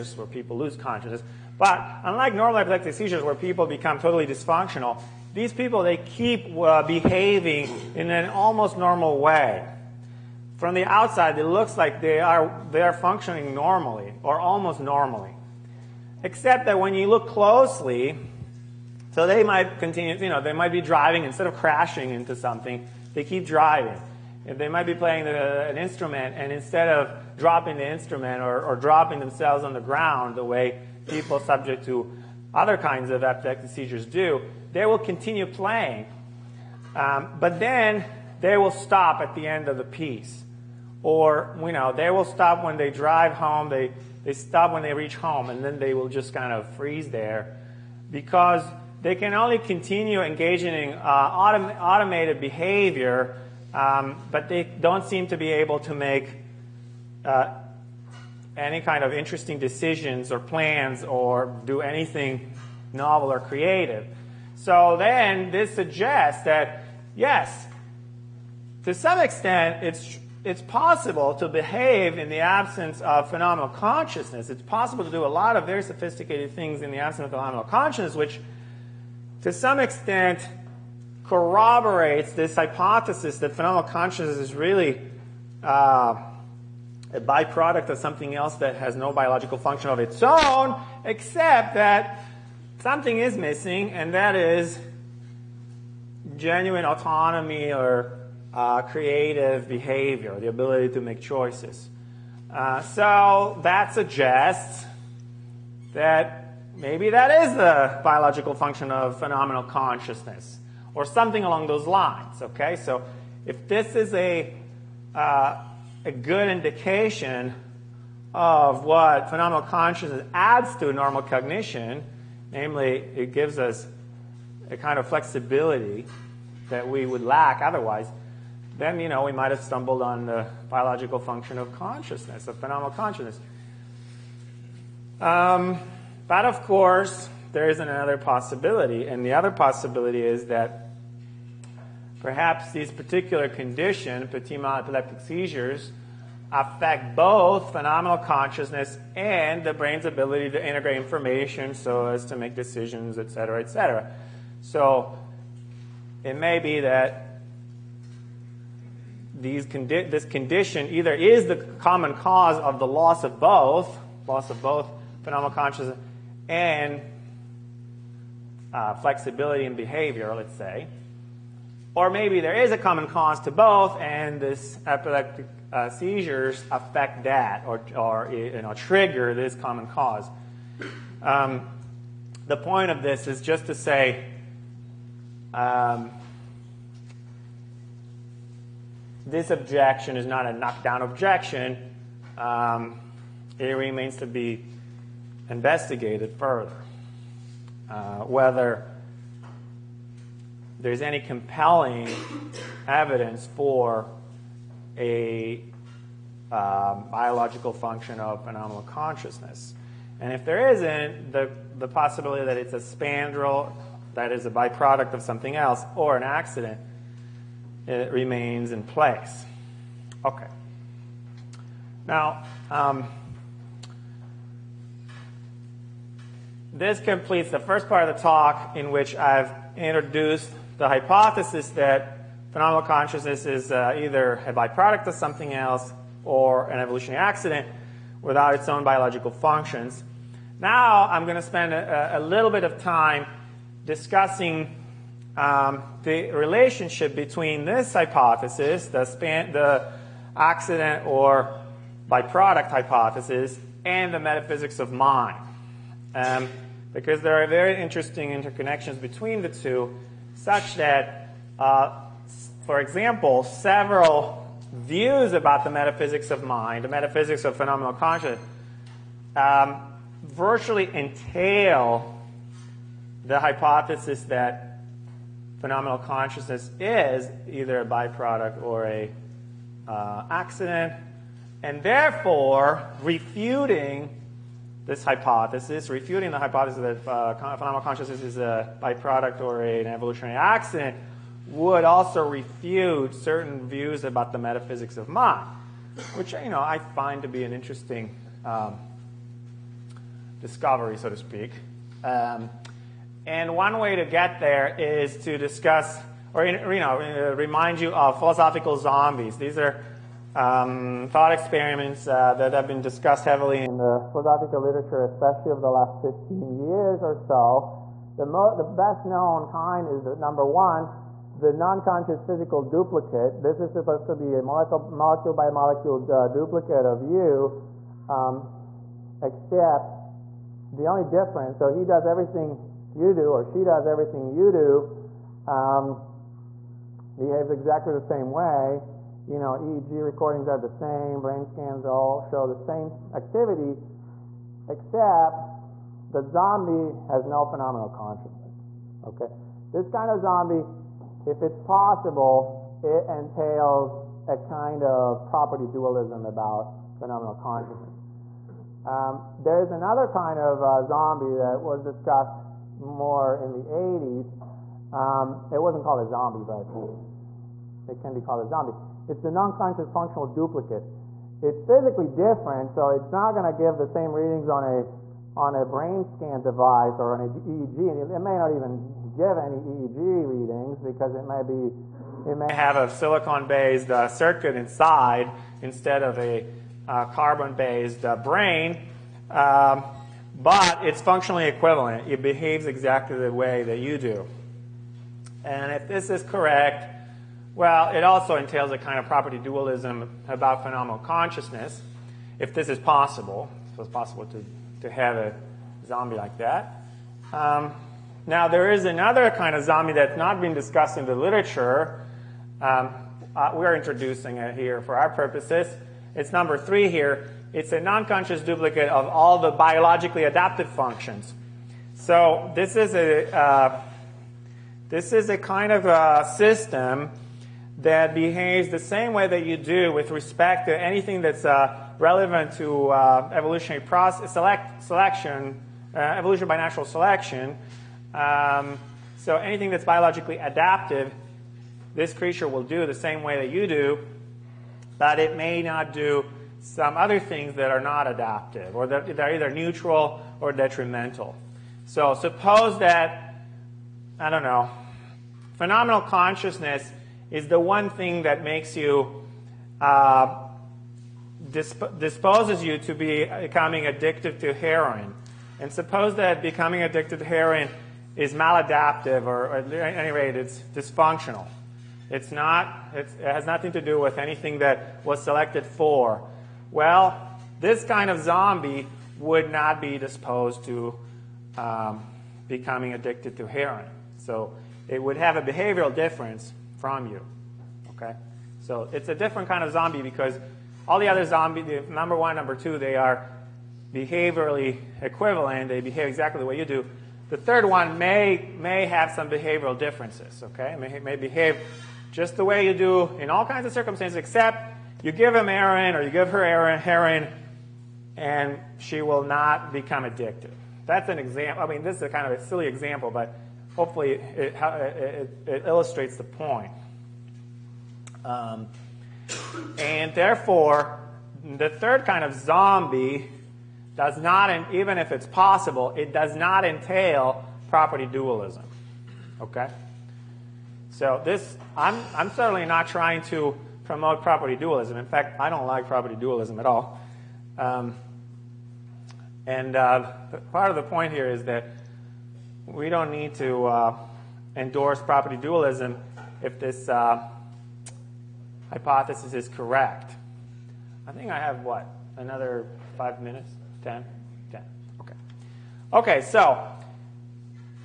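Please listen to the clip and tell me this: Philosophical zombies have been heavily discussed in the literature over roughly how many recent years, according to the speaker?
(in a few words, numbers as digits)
15.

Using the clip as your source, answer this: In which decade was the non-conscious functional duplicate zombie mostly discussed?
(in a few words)
the 80s.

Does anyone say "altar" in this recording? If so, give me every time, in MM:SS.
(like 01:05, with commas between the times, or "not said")
not said.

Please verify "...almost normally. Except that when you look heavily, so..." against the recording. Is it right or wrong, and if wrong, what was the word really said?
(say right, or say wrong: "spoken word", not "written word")
wrong: "closely", not "heavily".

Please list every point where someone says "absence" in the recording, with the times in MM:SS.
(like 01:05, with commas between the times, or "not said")
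01:12, 01:16.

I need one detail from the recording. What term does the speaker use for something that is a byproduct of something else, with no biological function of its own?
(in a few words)
spandrel.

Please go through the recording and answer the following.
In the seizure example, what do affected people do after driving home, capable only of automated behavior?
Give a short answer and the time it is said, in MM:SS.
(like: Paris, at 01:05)
freeze, at 00:46.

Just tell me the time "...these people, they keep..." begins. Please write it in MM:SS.
00:05.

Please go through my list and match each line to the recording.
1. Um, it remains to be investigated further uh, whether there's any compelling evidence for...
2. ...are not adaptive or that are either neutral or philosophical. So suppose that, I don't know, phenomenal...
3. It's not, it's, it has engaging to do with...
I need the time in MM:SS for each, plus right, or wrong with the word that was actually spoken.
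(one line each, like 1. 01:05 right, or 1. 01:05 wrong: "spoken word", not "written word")
1. 03:12 right
2. 07:27 wrong: "detrimental", not "philosophical"
3. 07:52 wrong: "nothing", not "engaging".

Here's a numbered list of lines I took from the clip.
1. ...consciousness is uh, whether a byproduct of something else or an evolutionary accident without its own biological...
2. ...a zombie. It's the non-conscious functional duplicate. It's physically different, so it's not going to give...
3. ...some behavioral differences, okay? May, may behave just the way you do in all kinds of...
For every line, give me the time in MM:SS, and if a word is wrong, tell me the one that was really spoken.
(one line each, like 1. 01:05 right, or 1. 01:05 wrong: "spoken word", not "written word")
1. 03:52 wrong: "either", not "whether"
2. 06:08 right
3. 08:19 right.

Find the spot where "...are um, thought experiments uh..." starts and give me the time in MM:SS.
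05:09.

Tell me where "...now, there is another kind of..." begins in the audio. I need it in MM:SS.
06:48.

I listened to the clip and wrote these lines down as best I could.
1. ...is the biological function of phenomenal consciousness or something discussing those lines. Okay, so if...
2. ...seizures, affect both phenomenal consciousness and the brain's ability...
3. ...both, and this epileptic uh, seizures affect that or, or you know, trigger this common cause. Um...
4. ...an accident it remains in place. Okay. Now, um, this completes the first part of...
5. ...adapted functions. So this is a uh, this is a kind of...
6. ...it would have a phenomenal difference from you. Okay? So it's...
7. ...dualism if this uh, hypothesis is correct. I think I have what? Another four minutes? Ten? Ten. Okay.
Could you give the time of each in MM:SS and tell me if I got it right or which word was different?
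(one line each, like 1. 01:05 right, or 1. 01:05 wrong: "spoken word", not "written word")
1. 01:47 wrong: "along", not "discussing"
2. 02:25 right
3. 02:53 right
4. 03:36 right
5. 07:00 right
6. 08:04 wrong: "behavioral", not "phenomenal"
7. 09:05 wrong: "five", not "four".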